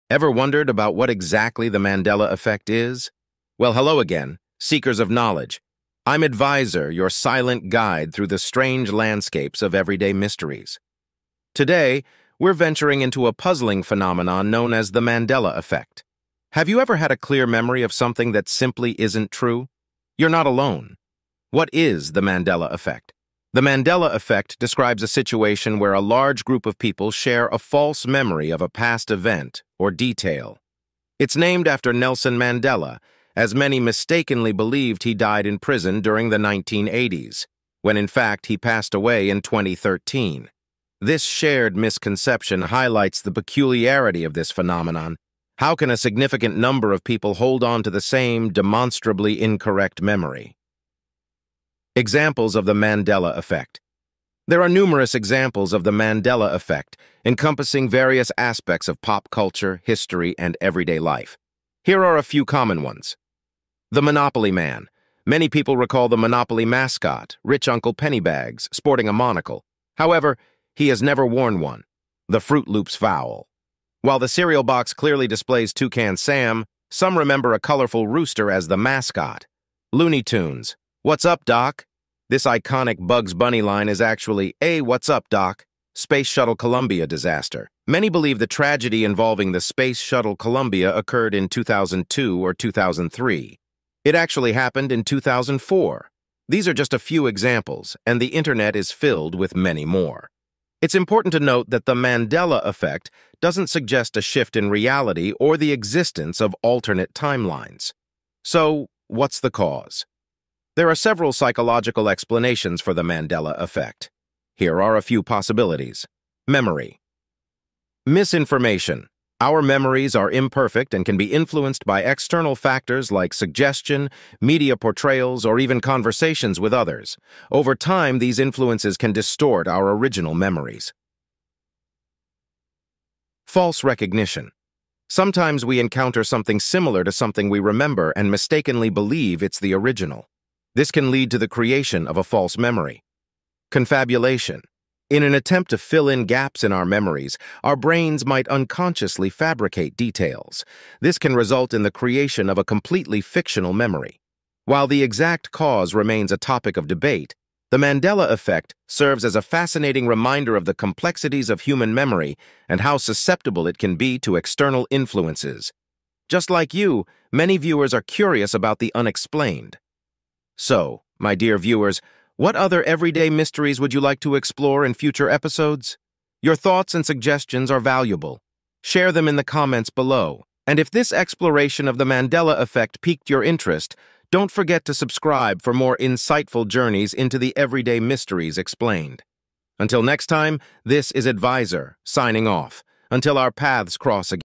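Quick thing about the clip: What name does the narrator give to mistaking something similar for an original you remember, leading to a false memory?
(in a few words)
False recognition.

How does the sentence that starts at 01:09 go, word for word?
However, he has never worn one.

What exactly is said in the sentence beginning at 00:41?
This shared misconception highlights the peculiarity of this phenomenon.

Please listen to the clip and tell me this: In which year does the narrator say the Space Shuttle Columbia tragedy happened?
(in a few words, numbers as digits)
2004.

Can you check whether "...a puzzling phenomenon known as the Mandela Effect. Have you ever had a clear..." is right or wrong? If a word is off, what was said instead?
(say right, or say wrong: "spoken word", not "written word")
right.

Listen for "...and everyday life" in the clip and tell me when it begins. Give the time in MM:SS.
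01:00.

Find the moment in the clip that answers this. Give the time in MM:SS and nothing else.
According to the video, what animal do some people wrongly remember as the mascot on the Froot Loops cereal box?
01:18.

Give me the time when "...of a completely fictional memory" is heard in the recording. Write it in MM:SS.
02:32.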